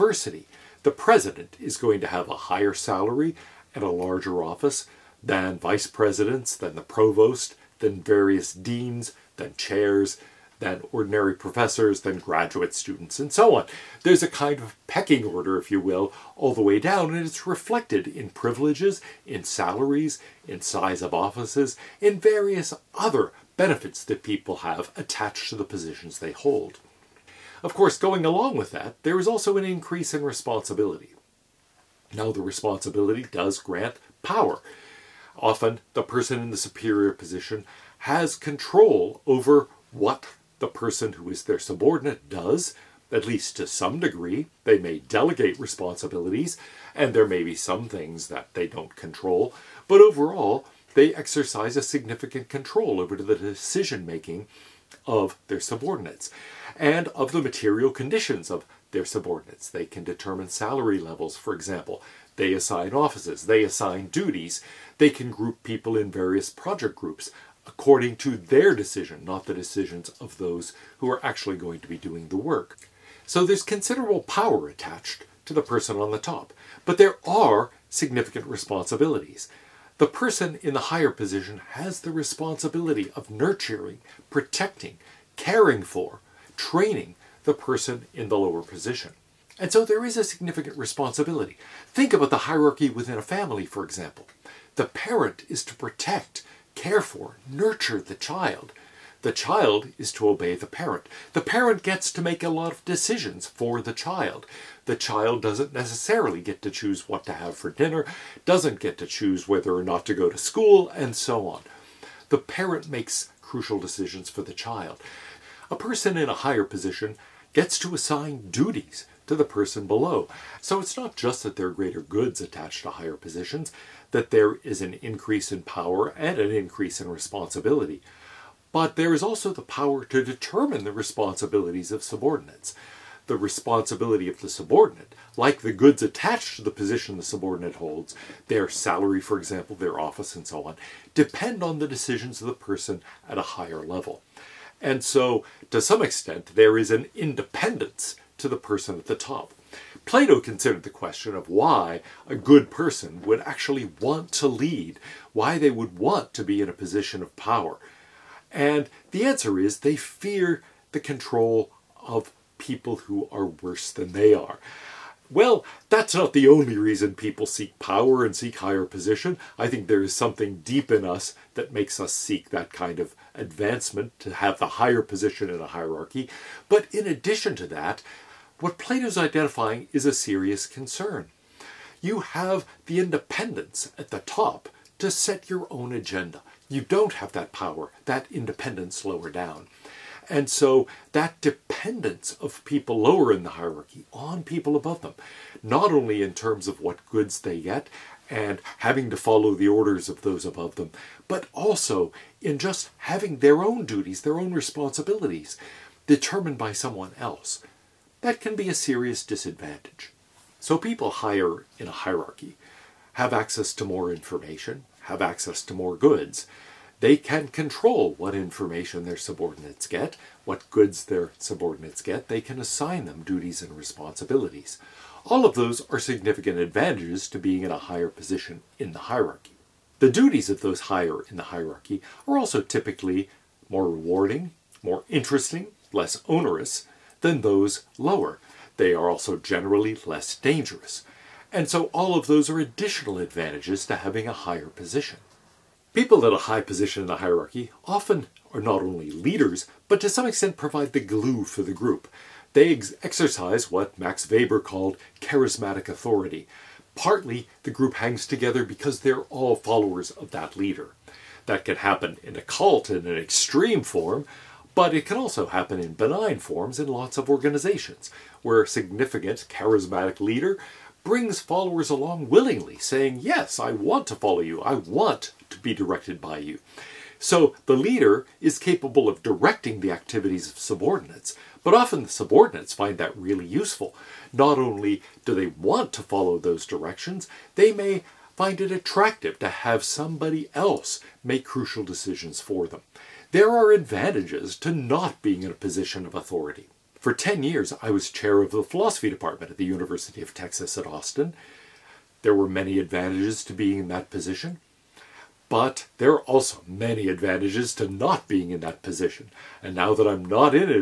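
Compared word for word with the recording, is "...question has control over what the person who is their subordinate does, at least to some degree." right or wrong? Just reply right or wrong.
wrong.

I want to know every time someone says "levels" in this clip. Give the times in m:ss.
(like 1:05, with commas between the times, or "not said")
1:00, 2:23.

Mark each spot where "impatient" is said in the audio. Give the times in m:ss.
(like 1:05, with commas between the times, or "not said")
not said.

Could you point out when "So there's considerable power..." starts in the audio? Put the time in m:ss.
1:13.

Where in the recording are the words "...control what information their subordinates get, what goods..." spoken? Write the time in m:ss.
3:37.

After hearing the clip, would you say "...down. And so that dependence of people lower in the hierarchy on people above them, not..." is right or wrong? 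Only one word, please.
right.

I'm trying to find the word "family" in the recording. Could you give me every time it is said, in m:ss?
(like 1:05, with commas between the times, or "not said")
1:33.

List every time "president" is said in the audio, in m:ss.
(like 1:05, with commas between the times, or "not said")
0:00, 0:05.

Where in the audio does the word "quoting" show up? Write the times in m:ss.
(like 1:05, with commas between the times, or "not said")
not said.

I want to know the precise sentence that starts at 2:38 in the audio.
And the answer is they fear the control of people who are worse than they are.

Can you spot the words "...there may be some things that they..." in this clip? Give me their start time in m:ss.
0:47.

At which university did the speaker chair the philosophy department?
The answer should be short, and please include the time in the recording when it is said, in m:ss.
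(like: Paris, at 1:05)
University of Texas at Austin, at 4:59.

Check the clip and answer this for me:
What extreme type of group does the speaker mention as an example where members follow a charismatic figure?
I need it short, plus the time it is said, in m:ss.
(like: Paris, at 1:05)
a cult, at 4:22.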